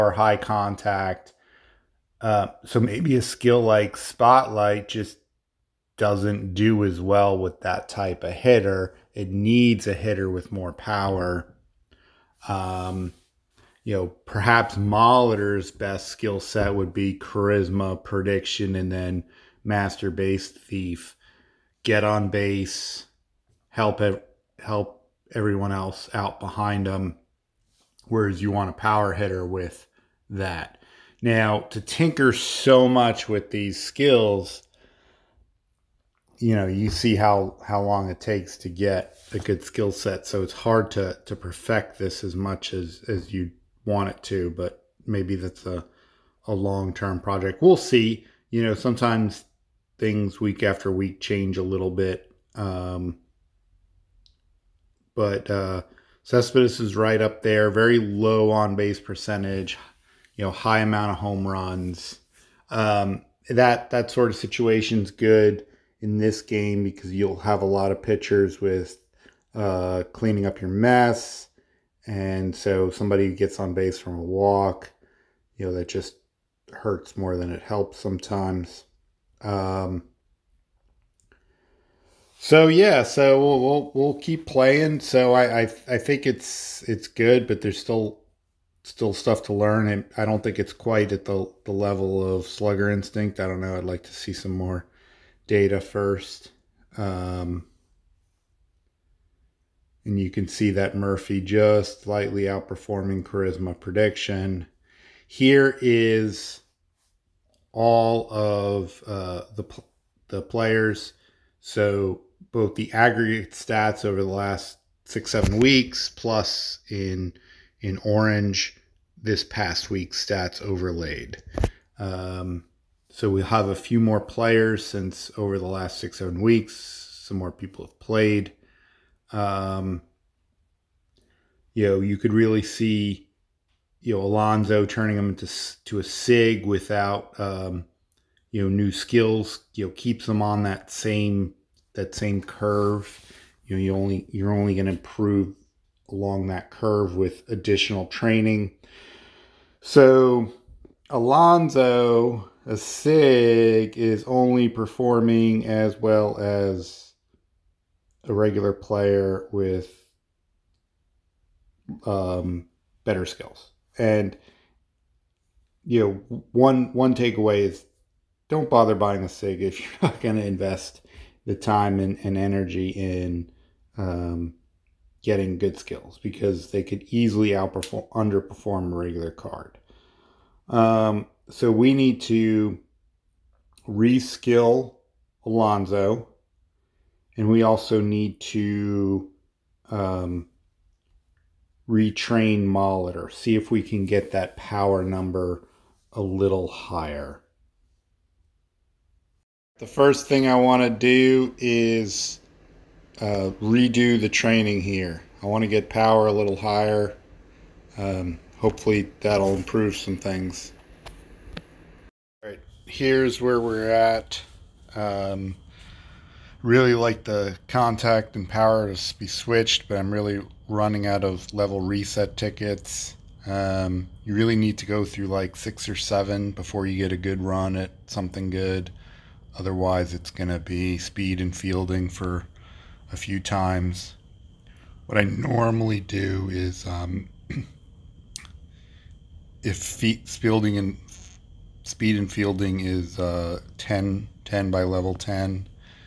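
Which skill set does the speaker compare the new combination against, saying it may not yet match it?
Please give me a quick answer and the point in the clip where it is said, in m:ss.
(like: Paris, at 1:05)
Slugger Instinct, at 1:32.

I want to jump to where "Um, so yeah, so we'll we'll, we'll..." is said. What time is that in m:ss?
1:19.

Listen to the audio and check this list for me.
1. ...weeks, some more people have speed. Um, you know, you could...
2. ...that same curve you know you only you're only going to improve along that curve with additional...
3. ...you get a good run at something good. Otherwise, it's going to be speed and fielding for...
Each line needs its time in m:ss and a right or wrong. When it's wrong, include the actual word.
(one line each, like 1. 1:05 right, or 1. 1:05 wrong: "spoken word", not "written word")
1. 2:06 wrong: "played", not "speed"
2. 2:21 right
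3. 3:46 right.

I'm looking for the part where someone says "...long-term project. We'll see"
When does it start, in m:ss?
0:46.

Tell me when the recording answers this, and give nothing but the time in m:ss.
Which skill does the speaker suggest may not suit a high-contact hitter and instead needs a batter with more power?
0:03.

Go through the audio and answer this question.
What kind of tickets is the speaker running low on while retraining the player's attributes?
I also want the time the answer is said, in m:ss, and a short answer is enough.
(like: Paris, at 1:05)
level reset tickets, at 3:41.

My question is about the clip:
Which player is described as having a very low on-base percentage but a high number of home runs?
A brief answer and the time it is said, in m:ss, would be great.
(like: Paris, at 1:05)
Cespedes, at 0:56.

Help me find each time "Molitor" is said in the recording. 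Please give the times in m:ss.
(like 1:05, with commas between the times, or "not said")
0:14, 3:12.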